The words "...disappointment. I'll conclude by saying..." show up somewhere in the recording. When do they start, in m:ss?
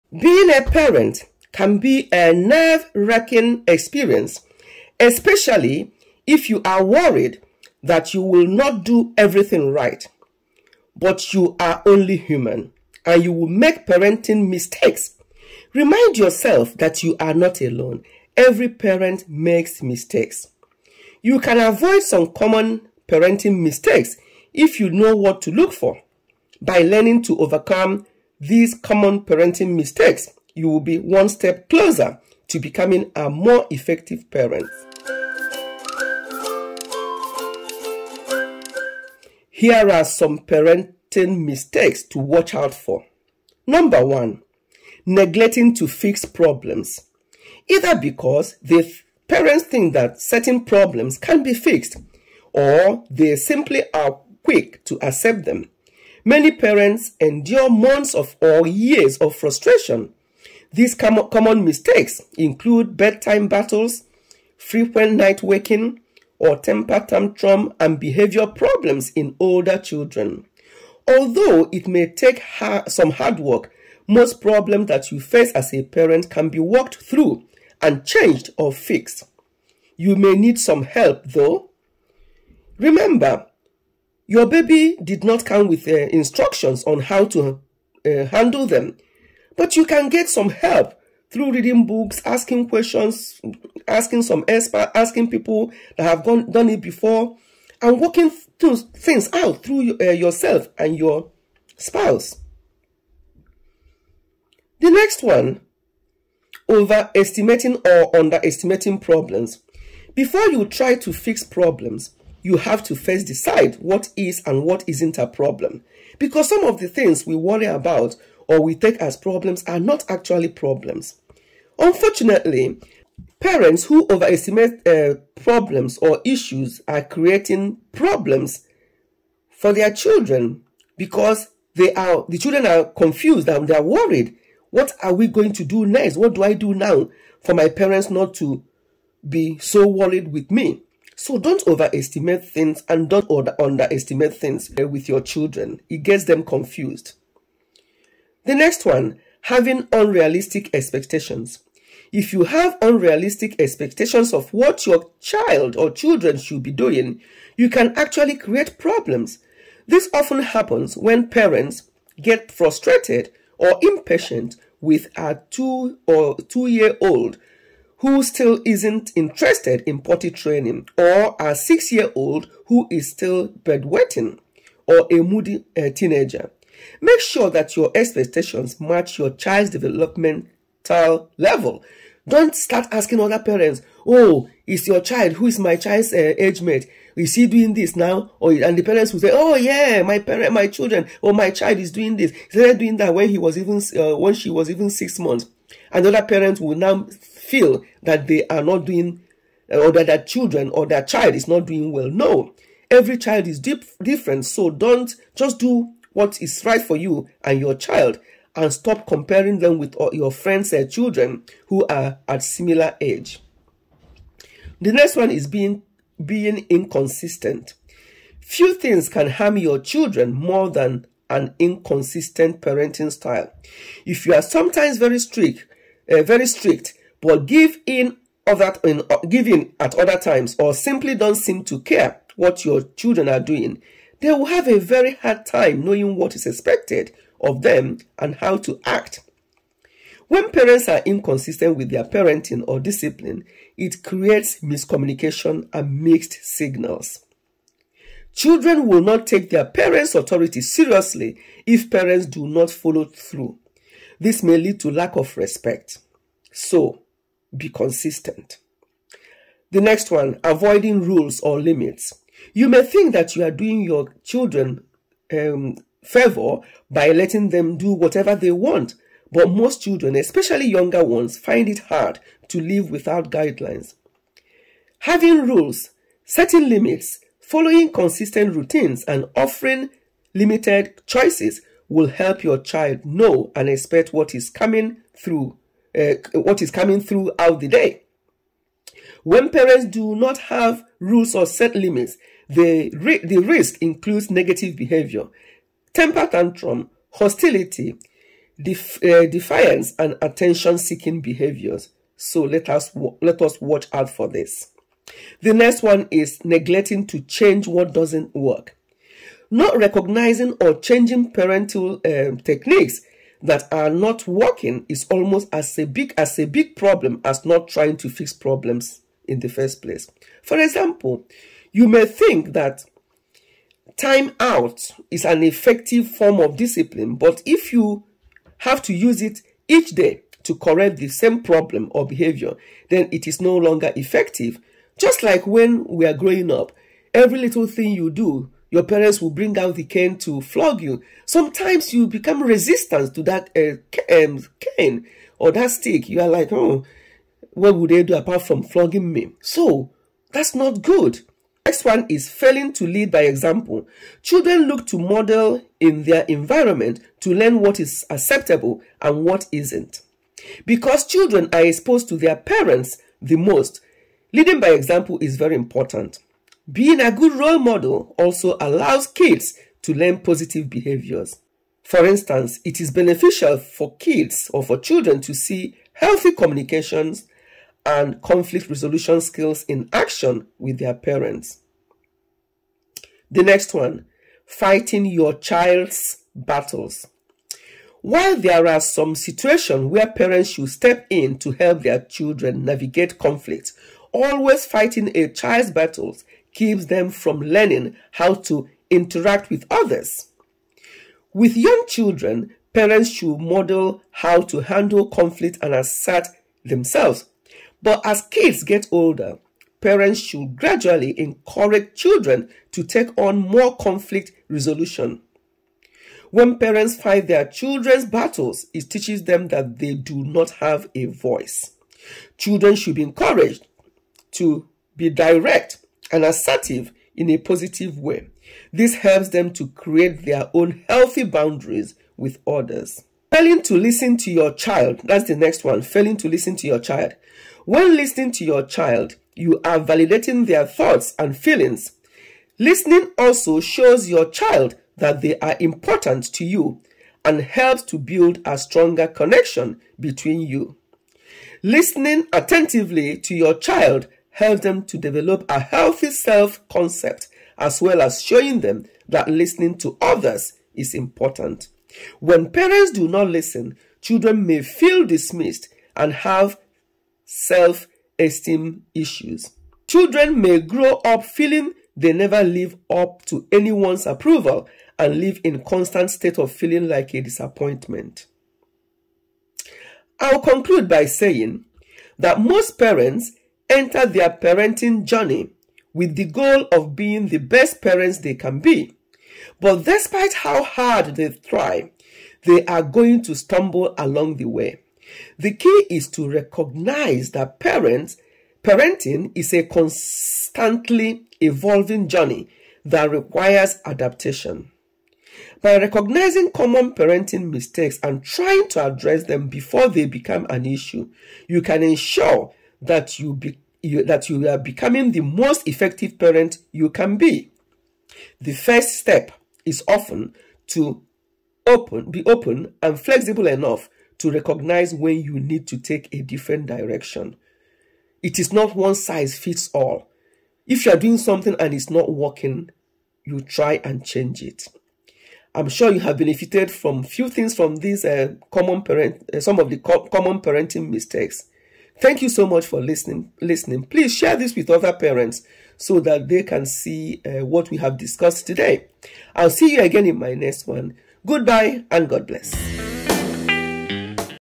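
7:57.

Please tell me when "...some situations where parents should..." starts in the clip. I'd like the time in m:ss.
6:28.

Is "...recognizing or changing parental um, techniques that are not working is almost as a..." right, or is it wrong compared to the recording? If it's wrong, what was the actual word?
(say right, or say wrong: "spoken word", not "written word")
right.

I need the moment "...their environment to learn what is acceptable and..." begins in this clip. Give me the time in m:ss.
5:56.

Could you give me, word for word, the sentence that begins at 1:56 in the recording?
Because some of the things we worry about or we take as problems are not actually problems.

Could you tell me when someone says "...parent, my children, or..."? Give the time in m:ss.
3:10.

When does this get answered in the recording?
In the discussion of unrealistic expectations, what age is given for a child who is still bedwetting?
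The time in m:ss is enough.
2:51.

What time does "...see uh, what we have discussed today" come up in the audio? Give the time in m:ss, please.
9:06.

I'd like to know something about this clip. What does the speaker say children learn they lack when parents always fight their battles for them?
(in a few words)
A voice.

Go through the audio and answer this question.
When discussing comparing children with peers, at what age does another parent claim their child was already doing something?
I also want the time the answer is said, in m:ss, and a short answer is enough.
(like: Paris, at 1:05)
6 months, at 3:14.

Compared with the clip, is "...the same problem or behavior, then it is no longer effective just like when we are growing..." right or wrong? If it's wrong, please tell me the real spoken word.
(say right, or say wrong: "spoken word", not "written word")
right.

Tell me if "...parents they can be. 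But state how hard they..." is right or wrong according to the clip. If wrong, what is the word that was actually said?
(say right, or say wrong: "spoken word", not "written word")
wrong: "despite", not "state".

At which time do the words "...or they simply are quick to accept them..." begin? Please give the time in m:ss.
0:52.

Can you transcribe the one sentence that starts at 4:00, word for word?
When parents are inconsistent with their parenting or discipline, it creates miscommunication and mixed signals.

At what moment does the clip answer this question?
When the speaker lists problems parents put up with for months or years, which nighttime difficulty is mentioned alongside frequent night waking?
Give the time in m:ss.
1:02.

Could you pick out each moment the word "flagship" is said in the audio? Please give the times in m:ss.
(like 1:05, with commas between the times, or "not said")
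not said.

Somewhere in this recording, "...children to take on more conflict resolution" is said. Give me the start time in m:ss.
6:51.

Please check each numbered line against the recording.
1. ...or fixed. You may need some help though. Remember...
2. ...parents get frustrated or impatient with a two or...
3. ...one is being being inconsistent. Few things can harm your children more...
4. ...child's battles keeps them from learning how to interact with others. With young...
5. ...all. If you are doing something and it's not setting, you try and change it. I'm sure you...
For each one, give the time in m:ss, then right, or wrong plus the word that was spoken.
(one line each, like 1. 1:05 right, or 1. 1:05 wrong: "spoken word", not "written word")
1. 1:18 right
2. 2:41 right
3. 3:35 right
4. 6:35 right
5. 8:49 wrong: "working", not "setting".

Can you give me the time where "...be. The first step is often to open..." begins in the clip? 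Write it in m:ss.
8:37.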